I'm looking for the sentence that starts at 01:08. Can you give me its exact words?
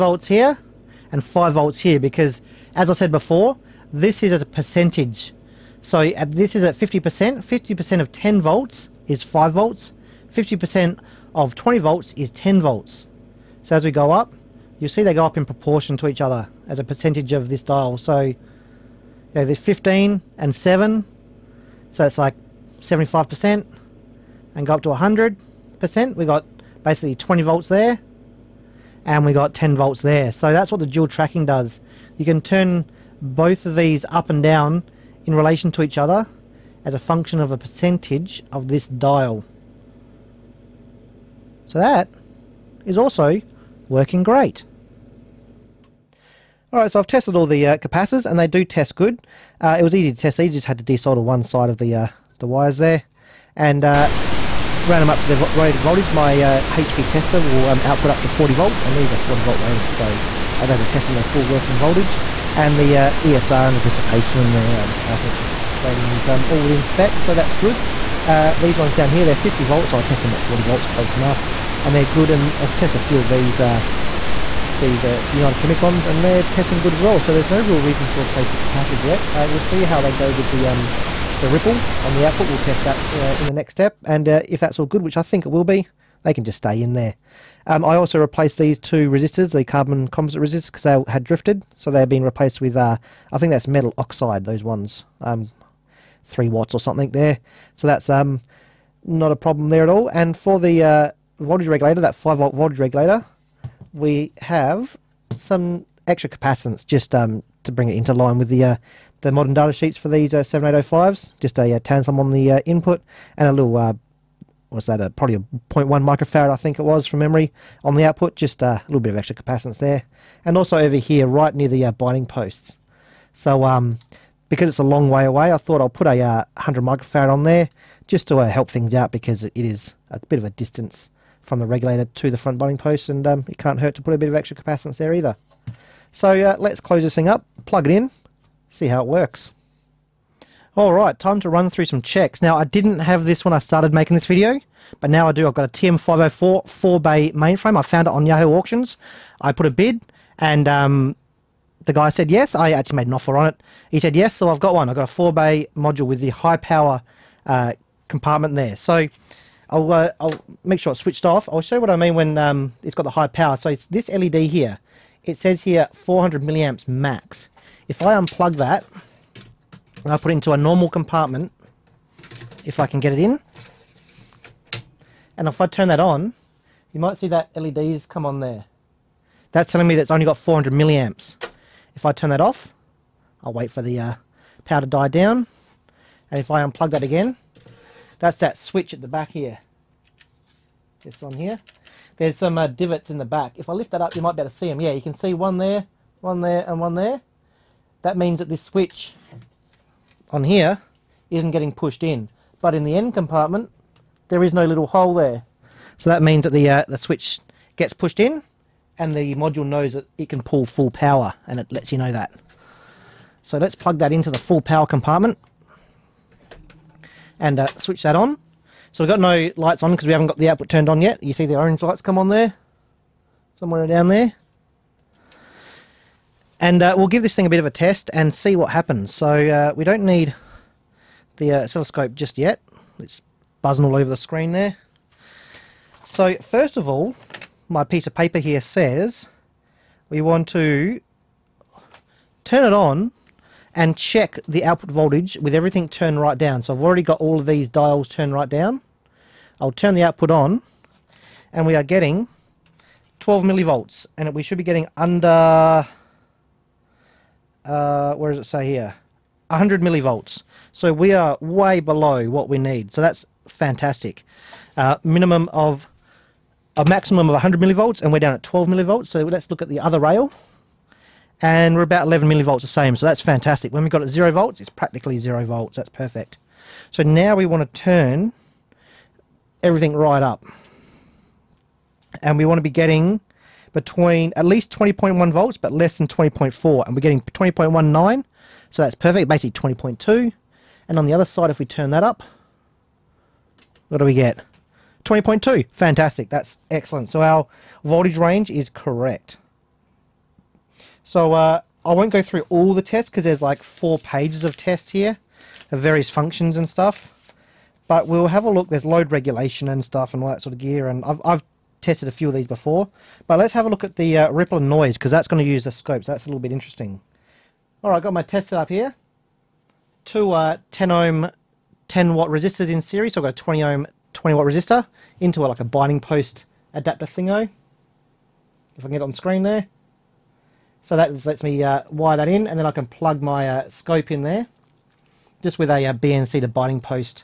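Uh, these ones down here, they're 50 volts.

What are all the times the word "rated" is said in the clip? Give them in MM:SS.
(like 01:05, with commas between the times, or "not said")
00:55, 00:59.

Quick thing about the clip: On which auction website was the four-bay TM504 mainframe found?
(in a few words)
Yahoo Auctions.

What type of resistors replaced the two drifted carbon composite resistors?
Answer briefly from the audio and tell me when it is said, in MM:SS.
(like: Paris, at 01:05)
metal oxide, at 01:33.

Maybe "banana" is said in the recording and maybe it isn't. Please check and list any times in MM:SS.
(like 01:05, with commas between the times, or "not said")
not said.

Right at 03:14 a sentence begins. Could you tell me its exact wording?
Yeah, you can see one there, one there, and one there.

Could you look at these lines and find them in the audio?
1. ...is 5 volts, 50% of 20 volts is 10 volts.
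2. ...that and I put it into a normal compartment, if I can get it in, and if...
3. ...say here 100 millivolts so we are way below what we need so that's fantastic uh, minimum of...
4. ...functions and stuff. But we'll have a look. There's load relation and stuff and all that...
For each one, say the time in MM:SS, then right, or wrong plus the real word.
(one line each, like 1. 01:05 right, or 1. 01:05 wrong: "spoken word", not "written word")
1. 00:09 right
2. 02:48 right
3. 04:18 right
4. 05:06 wrong: "regulation", not "relation".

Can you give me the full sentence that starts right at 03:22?
But in the end compartment, there is no little hole there.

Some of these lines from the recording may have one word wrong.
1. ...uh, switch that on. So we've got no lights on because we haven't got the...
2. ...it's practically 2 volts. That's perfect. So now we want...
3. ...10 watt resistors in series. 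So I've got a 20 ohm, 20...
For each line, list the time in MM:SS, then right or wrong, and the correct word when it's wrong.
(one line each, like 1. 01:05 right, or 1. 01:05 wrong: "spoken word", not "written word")
1. 03:37 right
2. 04:34 wrong: "0", not "2"
3. 05:21 right.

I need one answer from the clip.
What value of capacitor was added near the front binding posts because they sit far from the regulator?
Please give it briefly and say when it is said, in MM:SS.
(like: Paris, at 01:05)
100 microfarad, at 02:06.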